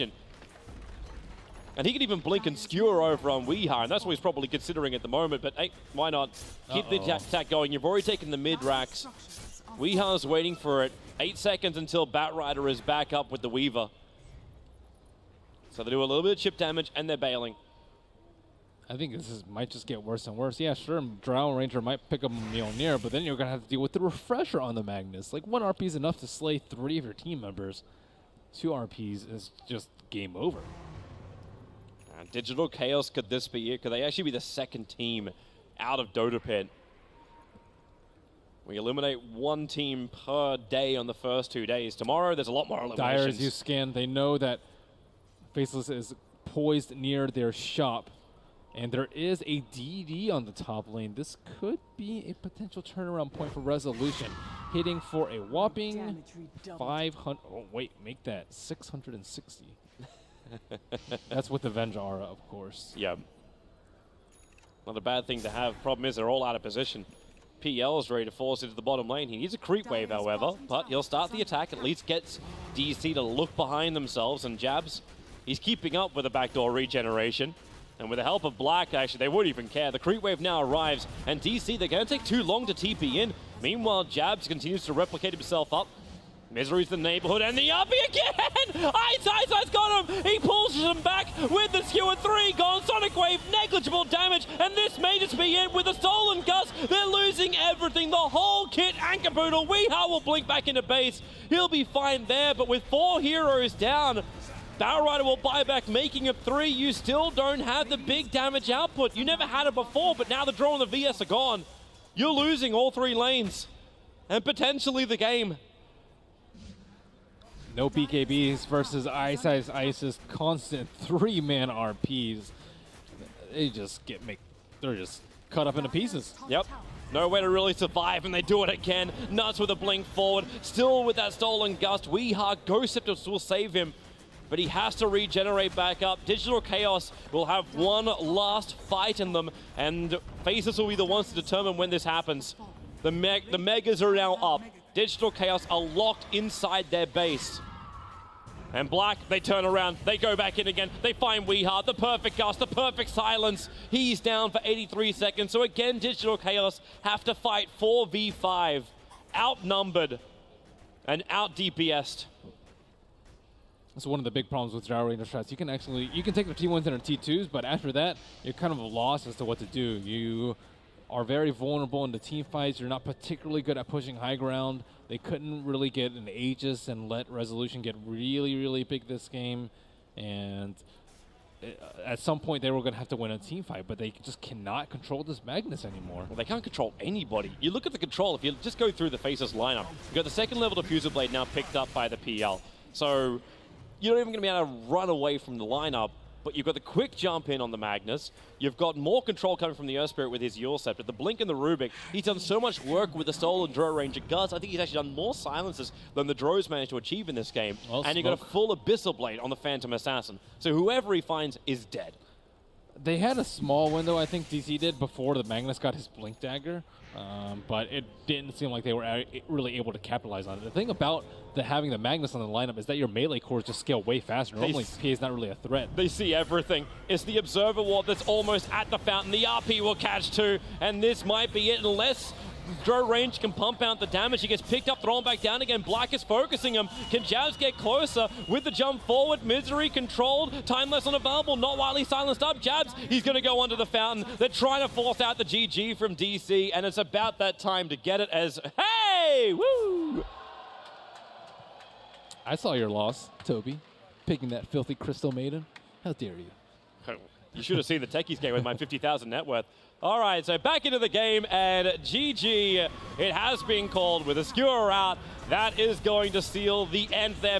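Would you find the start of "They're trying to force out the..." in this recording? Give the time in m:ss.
4:04.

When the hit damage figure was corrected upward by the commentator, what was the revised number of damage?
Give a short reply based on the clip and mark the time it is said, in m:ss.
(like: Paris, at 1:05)
660, at 0:58.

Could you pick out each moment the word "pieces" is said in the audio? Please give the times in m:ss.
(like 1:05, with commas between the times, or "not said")
2:05.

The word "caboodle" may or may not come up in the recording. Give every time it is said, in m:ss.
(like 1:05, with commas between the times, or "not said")
1:39.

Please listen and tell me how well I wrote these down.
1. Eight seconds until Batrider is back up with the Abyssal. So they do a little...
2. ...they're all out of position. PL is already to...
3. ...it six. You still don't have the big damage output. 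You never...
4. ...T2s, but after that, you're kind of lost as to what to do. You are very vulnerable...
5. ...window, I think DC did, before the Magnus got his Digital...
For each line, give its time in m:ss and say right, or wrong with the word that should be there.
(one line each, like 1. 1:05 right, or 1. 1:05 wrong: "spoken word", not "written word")
1. 0:11 wrong: "Weaver", not "Abyssal"
2. 1:06 wrong: "ready", not "already"
3. 1:46 wrong: "three", not "six"
4. 2:47 right
5. 3:33 wrong: "Blink", not "Digital".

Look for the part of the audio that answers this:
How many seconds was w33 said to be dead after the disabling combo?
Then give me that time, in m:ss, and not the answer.
2:34.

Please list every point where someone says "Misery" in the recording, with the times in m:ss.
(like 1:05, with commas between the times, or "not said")
1:26, 3:59.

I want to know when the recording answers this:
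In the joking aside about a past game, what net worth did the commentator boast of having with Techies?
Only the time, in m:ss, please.
4:18.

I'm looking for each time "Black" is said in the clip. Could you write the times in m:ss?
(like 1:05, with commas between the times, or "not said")
1:18, 2:28, 3:55.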